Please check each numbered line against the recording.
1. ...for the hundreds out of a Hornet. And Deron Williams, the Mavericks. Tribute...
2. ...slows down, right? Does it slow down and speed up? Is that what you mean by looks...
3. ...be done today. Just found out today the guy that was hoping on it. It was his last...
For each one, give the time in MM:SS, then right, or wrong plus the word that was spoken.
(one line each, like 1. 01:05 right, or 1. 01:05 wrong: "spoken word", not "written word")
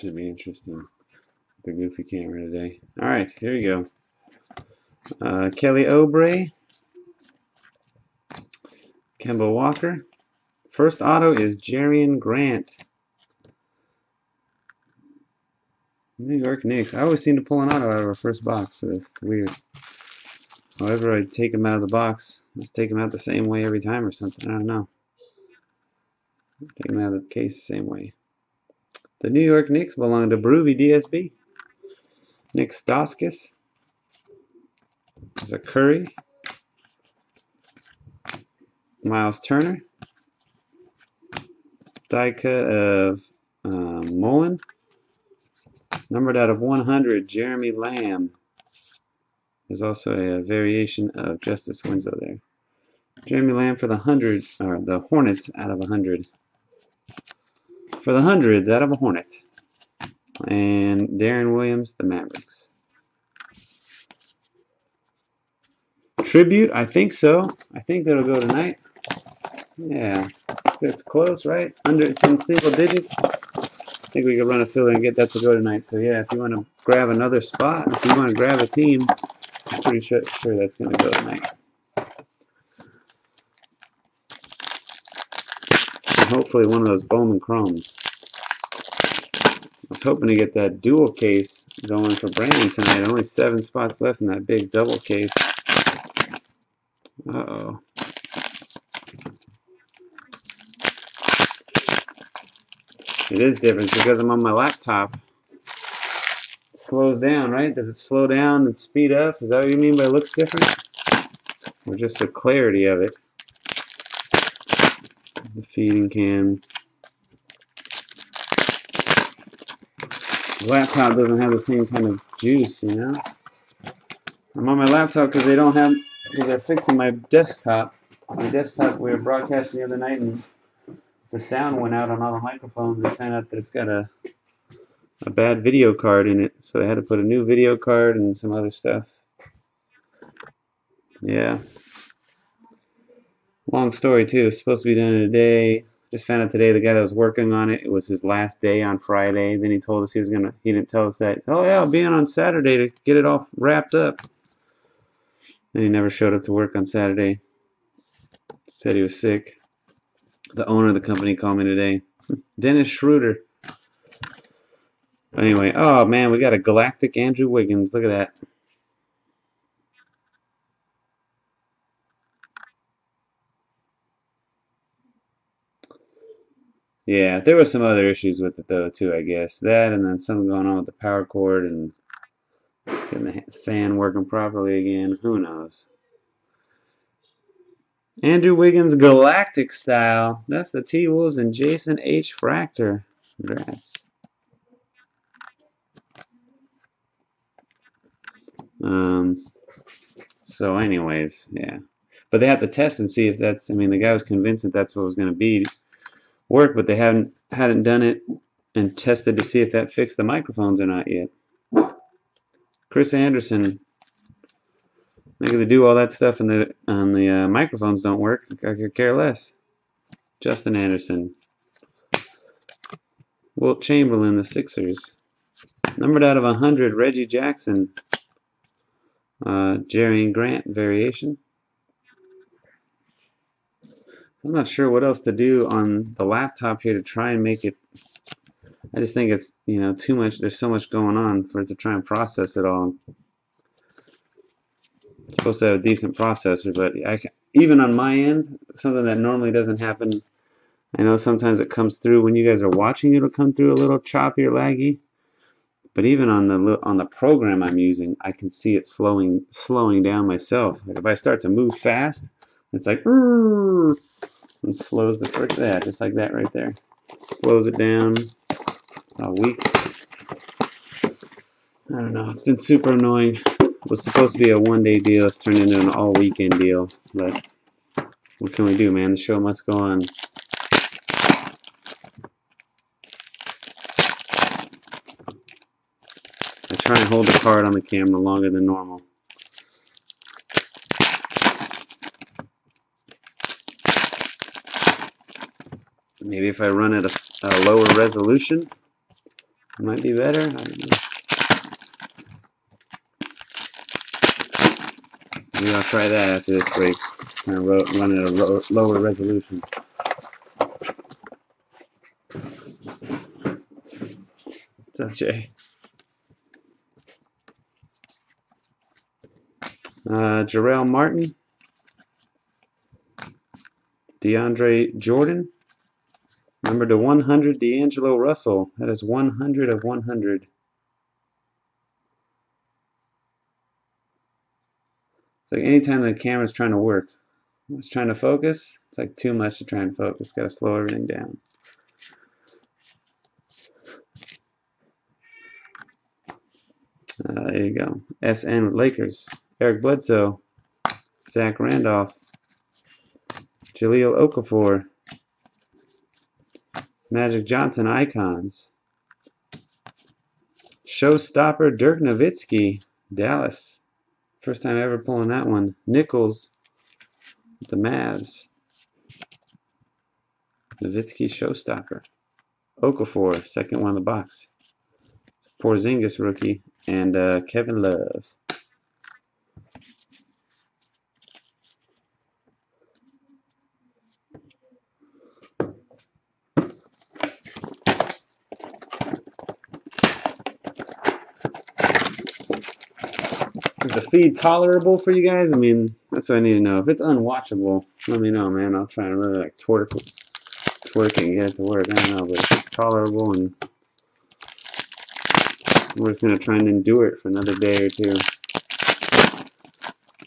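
1. 00:58 right
2. 01:46 right
3. 02:24 wrong: "working", not "hoping".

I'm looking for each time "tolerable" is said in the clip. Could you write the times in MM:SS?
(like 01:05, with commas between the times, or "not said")
06:34, 06:42.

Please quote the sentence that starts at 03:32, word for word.
Chris Anderson, they do all that stuff and the and the uh, microphones don't work.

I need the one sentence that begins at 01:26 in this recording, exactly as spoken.
hopefully one of those Bowman Chromes.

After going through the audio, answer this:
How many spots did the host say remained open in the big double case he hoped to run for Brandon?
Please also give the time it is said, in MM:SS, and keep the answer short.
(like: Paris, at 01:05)
7, at 01:33.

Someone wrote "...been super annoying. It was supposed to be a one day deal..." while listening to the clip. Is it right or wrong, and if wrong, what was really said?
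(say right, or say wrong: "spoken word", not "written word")
right.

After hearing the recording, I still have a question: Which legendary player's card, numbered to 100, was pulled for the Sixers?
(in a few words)
Wilt Chamberlain.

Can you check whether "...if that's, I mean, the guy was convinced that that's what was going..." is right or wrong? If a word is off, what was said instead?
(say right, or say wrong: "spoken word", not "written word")
right.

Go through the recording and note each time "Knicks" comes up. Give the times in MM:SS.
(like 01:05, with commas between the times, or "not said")
00:16, 00:29.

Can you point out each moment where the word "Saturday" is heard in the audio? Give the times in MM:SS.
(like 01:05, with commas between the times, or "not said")
02:32, 02:36.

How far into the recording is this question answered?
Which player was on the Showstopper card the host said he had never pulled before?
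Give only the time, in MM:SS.
06:01.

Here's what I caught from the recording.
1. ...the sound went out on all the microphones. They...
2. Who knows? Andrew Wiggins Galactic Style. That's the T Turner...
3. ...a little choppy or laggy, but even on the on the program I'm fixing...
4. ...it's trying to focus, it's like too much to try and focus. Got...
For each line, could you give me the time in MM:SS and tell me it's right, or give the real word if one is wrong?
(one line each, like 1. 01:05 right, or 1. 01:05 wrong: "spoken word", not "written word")
1. 02:11 right
2. 03:05 wrong: "Wolves", not "Turner"
3. 04:13 wrong: "using", not "fixing"
4. 05:37 right.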